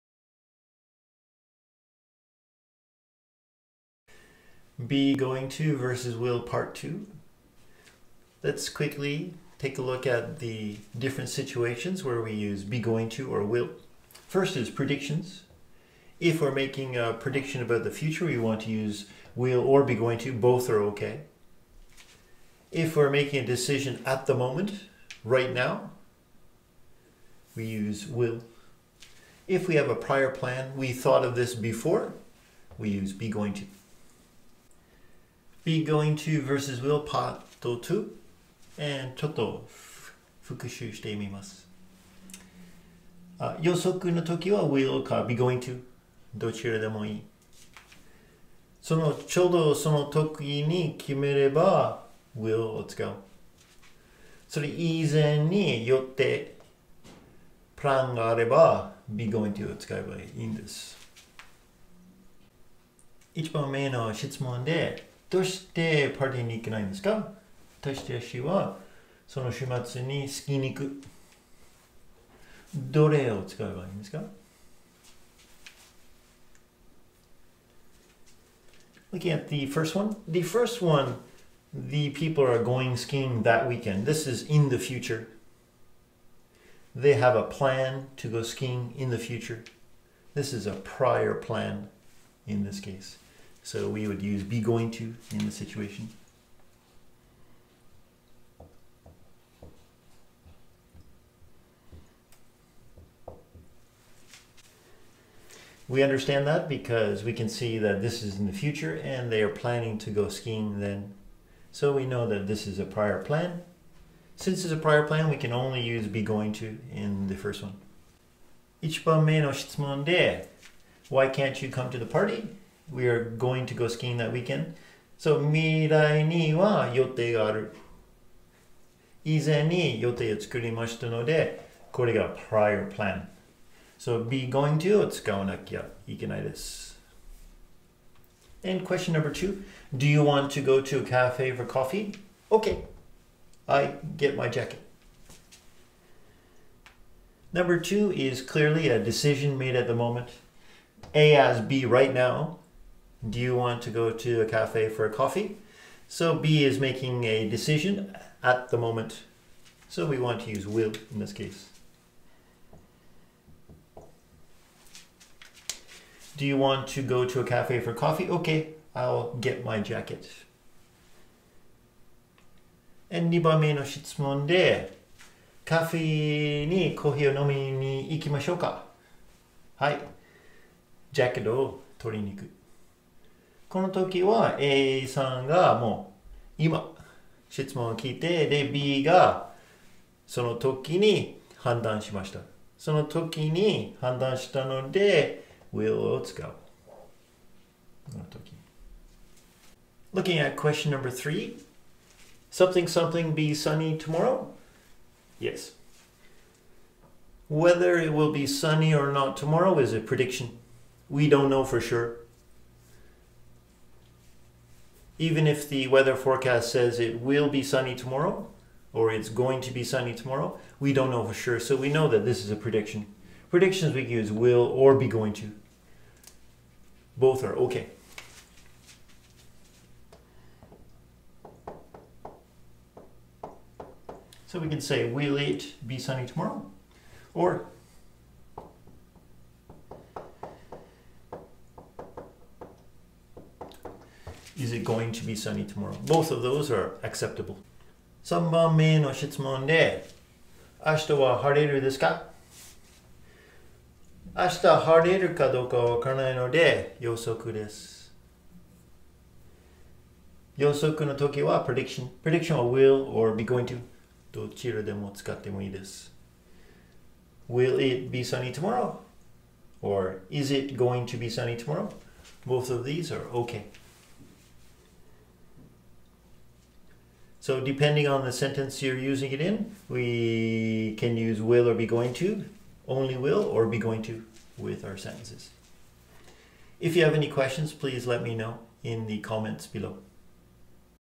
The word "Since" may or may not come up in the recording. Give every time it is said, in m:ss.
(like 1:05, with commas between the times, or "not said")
1:54.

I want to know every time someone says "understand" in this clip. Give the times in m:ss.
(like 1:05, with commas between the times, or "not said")
1:46.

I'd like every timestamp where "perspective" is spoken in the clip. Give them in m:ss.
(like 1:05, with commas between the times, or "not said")
not said.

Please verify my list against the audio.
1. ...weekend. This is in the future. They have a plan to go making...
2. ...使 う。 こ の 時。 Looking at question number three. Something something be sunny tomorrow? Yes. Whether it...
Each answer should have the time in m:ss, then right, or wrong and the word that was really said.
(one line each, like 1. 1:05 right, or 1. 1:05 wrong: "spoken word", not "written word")
1. 1:23 wrong: "skiing", not "making"
2. 3:16 right.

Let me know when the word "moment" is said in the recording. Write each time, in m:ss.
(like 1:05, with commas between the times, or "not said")
0:24, 2:29, 2:38.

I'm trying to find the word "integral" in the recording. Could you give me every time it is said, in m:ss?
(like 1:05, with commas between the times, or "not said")
not said.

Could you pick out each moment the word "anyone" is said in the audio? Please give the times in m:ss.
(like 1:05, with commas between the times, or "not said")
not said.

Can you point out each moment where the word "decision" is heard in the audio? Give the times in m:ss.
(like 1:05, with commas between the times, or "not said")
0:23, 2:29, 2:37.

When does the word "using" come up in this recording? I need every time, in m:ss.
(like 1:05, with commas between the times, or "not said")
4:38.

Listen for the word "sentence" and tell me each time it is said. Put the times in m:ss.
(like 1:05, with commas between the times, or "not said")
4:38, 4:44.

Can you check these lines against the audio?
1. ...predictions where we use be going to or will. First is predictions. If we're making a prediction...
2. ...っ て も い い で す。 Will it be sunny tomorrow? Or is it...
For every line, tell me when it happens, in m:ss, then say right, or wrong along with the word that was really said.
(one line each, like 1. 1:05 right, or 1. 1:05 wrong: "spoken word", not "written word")
1. 0:11 wrong: "situations", not "predictions"
2. 4:25 right.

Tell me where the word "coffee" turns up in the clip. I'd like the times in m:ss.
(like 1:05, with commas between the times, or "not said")
2:21, 2:35, 2:47.